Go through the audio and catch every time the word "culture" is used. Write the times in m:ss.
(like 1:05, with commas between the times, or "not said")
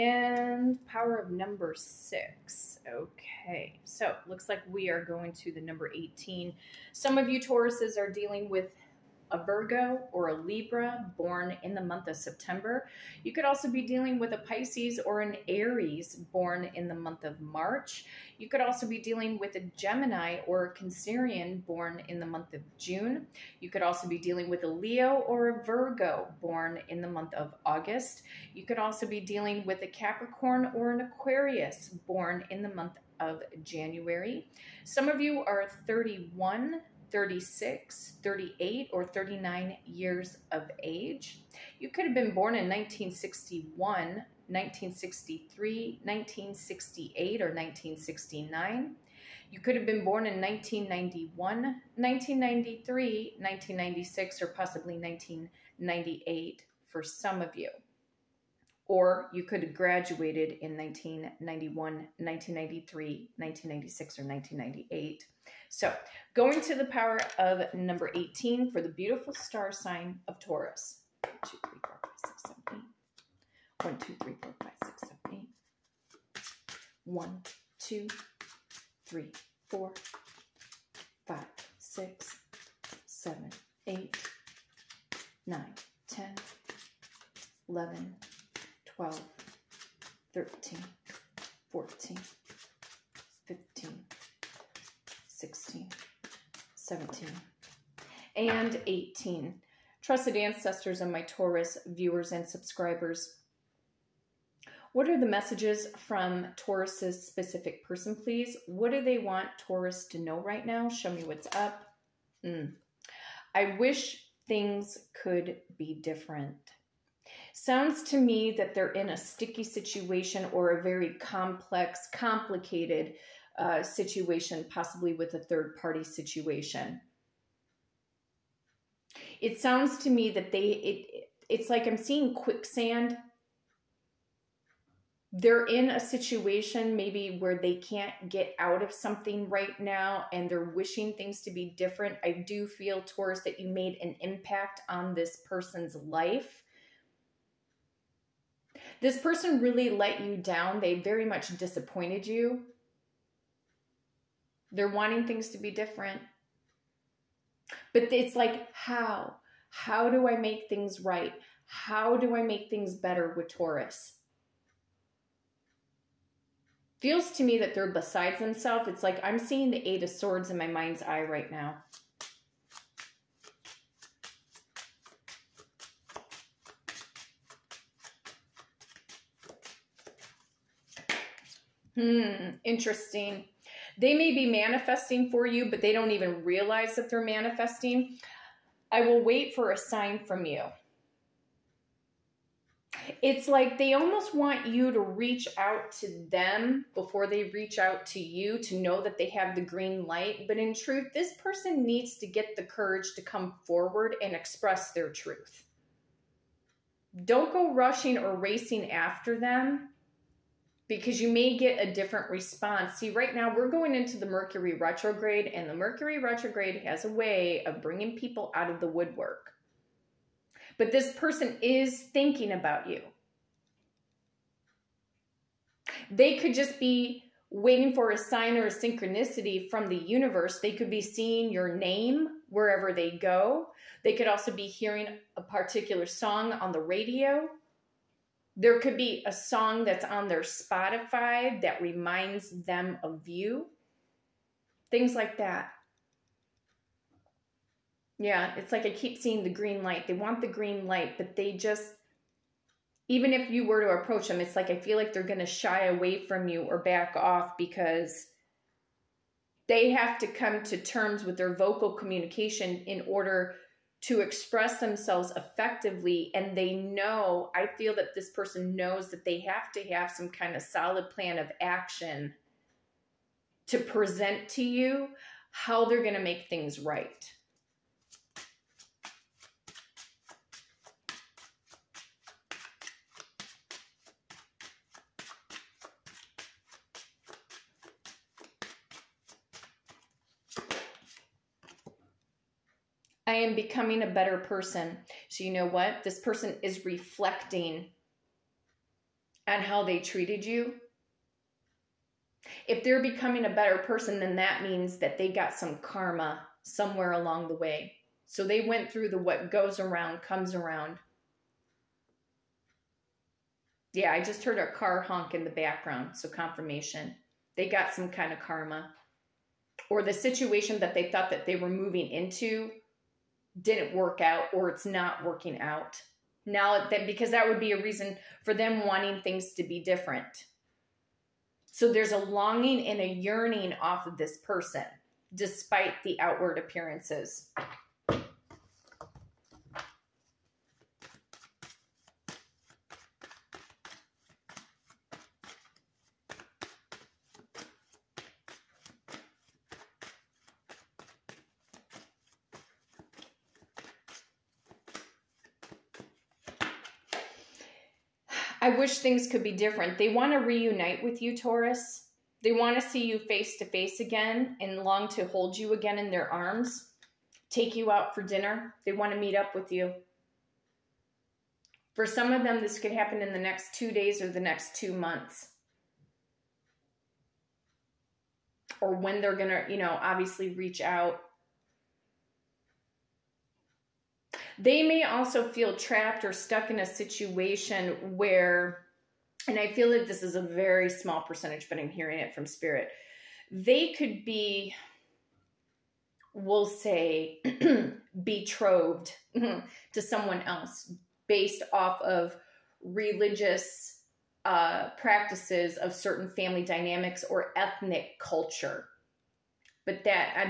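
6:48.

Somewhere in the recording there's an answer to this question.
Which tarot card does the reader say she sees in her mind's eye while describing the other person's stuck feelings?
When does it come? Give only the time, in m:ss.
2:49.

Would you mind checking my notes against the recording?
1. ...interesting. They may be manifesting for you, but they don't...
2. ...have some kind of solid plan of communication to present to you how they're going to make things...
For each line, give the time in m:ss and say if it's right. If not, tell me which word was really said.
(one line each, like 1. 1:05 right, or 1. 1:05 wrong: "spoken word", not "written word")
1. 3:02 right
2. 4:29 wrong: "action", not "communication".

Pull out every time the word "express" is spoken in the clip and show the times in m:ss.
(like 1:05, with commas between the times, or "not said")
3:24, 4:24.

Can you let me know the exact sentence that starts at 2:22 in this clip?
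I do feel, Taurus, that you made an impact on this person's life this person really let you down.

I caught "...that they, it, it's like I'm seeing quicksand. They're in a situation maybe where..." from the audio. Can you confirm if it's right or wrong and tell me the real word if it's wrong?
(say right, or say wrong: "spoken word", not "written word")
right.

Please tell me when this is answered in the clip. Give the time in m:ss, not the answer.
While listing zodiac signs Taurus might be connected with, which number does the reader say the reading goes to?
0:05.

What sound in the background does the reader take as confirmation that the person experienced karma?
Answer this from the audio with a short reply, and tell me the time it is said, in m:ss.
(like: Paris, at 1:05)
A car honk, at 5:14.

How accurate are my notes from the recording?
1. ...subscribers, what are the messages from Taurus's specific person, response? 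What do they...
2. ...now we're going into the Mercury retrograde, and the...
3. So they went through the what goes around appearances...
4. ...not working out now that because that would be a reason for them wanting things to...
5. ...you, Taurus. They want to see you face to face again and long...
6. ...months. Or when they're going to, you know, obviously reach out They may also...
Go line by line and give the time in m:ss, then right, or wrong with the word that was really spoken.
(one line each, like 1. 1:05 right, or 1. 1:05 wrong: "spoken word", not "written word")
1. 1:42 wrong: "please", not "response"
2. 3:33 right
3. 5:08 wrong: "comes", not "appearances"
4. 5:24 right
5. 6:01 right
6. 6:14 right.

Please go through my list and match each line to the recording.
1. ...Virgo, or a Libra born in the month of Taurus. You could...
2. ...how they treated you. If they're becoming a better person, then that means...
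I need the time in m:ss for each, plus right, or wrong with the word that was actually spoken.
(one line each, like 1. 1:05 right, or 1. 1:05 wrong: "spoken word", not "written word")
1. 0:09 wrong: "September", not "Taurus"
2. 4:59 right.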